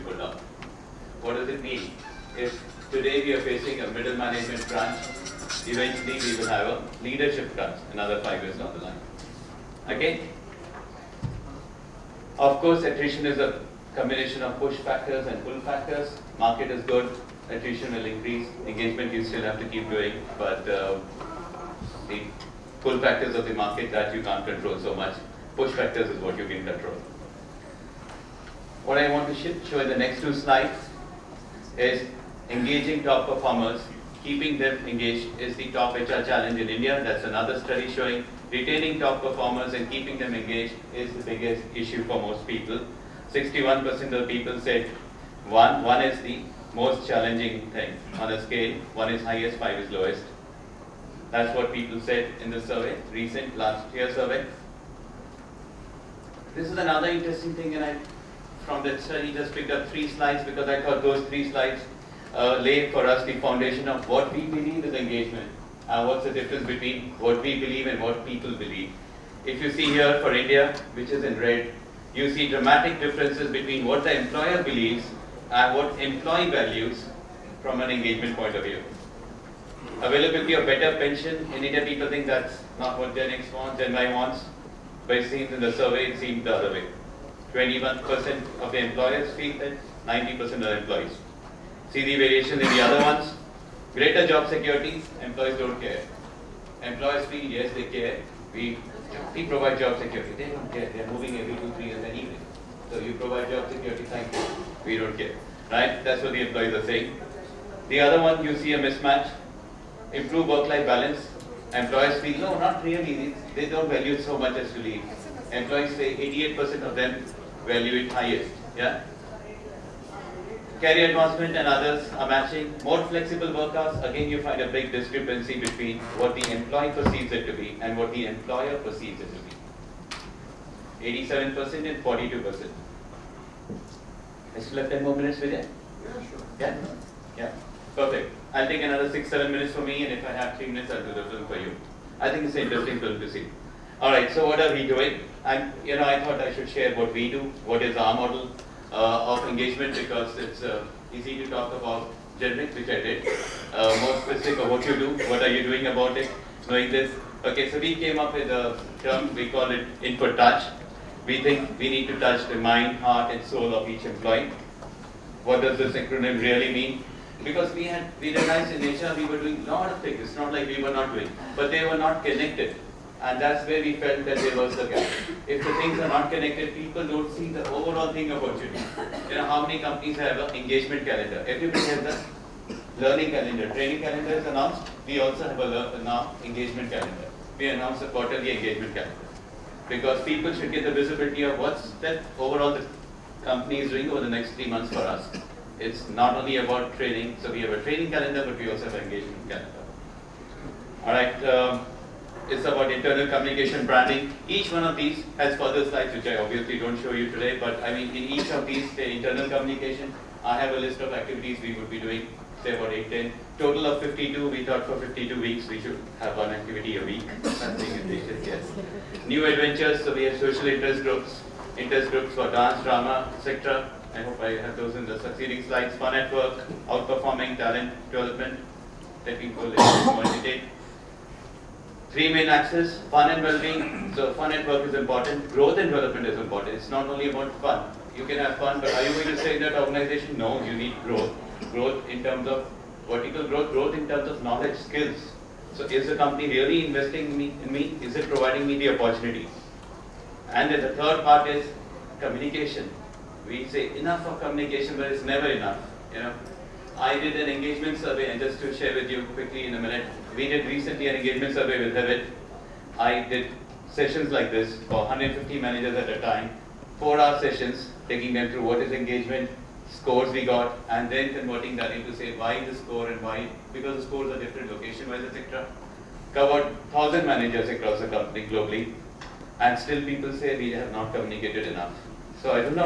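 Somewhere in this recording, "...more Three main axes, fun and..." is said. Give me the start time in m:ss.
3:50.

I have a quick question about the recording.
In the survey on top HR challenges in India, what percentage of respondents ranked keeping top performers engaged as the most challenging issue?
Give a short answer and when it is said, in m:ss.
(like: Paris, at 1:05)
61%, at 0:43.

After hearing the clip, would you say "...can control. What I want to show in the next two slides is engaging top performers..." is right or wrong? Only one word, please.
right.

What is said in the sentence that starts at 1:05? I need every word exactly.
Uh, what's the difference between what we believe and what people believe?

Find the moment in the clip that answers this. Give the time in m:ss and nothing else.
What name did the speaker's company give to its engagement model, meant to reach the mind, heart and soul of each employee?
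2:40.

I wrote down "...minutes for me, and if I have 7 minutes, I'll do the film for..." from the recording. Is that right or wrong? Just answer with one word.
wrong.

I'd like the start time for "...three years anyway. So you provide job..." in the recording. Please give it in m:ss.
1:41.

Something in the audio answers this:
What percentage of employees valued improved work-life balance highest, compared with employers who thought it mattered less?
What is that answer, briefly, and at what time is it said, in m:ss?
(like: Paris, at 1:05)
88%, at 1:56.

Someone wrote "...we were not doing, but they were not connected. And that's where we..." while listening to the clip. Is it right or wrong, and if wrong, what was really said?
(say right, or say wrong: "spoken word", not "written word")
right.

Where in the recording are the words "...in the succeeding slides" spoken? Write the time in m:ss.
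3:44.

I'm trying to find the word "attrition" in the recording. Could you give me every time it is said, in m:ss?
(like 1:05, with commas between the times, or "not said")
0:12, 0:17.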